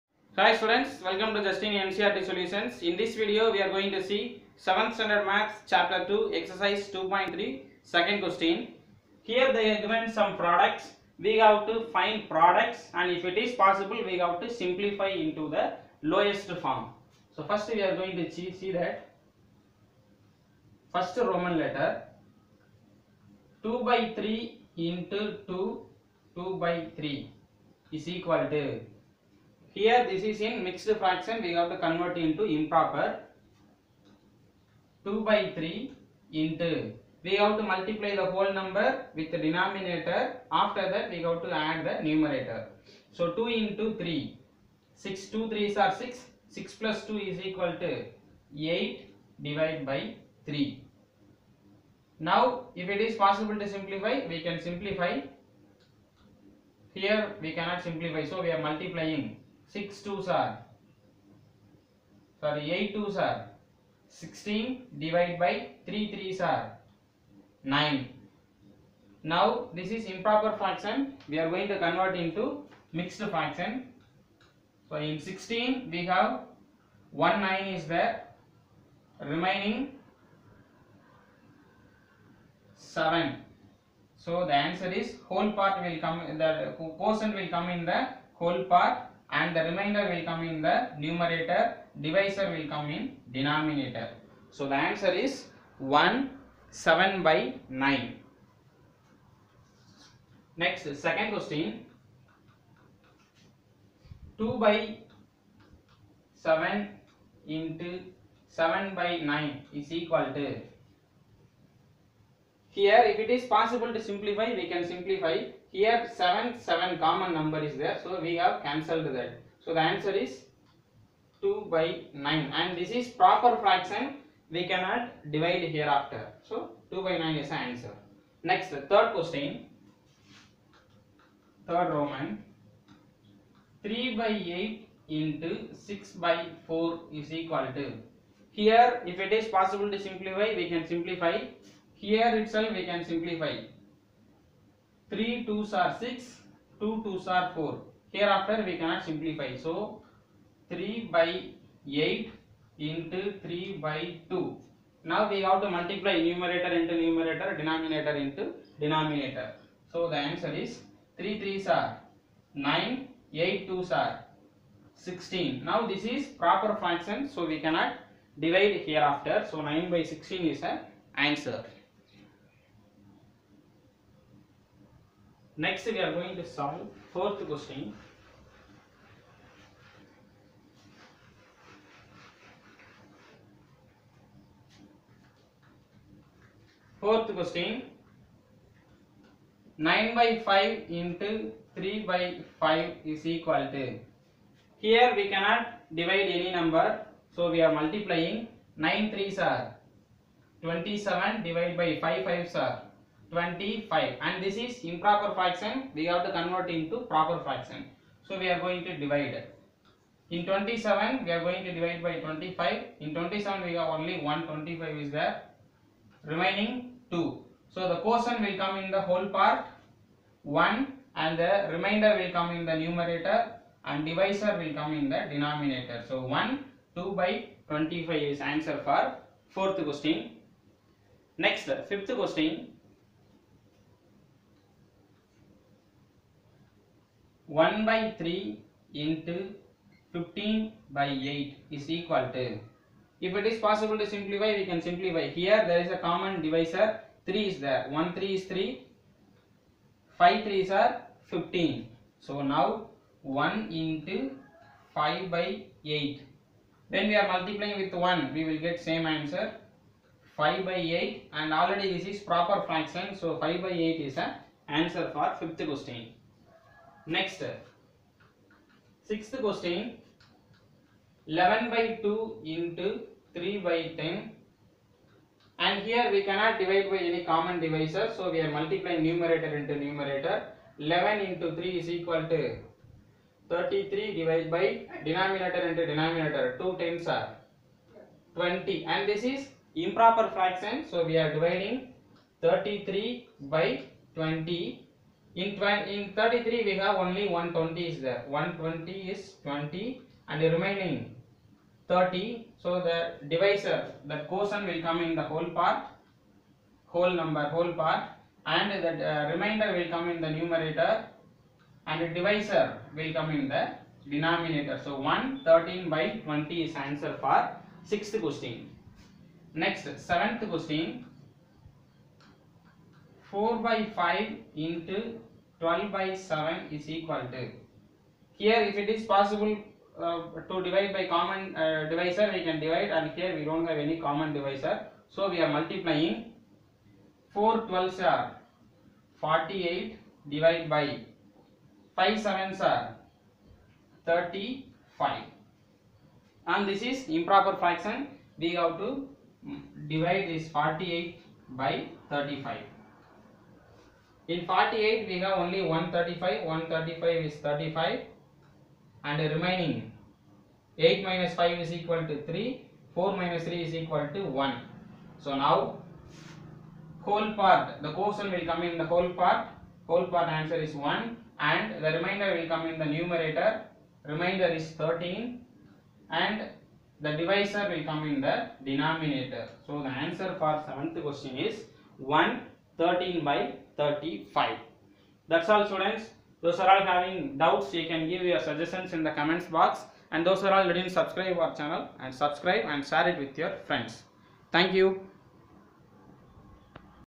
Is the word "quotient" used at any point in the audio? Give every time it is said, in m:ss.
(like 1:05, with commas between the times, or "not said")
1:26, 3:38, 5:04, 6:07.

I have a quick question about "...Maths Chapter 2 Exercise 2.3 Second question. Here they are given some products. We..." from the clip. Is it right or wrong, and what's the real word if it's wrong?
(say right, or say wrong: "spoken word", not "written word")
right.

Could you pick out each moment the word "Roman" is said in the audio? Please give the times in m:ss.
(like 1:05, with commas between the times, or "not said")
0:21, 2:11.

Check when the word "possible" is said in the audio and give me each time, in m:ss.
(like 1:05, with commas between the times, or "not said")
0:13, 0:53, 1:53, 2:19, 4:03, 5:29.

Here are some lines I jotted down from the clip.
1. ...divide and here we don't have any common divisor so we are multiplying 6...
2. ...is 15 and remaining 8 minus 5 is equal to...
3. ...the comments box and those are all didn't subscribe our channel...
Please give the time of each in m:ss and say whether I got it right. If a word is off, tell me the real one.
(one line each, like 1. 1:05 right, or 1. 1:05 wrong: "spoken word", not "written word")
1. 5:32 wrong: "4", not "6"
2. 5:57 wrong: "35", not "15"
3. 6:29 right.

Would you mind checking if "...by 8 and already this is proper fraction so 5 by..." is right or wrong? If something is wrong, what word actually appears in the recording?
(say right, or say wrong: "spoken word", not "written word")
right.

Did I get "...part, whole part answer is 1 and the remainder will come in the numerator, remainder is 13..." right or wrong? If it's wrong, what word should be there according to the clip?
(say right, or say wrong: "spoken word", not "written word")
right.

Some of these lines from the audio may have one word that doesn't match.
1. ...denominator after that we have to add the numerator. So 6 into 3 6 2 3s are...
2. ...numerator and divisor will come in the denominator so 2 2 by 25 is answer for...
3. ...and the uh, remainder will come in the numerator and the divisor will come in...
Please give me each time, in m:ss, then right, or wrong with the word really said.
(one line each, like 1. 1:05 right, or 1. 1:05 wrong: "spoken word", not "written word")
1. 0:39 wrong: "2", not "6"
2. 3:42 wrong: "1", not "2"
3. 5:08 right.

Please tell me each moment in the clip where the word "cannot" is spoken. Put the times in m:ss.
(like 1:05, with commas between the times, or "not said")
0:57, 2:04, 2:28, 2:47, 3:15, 4:36.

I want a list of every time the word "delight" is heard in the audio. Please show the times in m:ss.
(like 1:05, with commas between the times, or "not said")
not said.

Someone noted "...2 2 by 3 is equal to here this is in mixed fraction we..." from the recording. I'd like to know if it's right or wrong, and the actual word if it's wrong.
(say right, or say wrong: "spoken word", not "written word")
right.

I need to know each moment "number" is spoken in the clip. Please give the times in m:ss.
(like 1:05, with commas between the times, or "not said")
0:38, 1:57, 3:16, 5:07.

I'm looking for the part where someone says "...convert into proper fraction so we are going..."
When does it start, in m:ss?
3:26.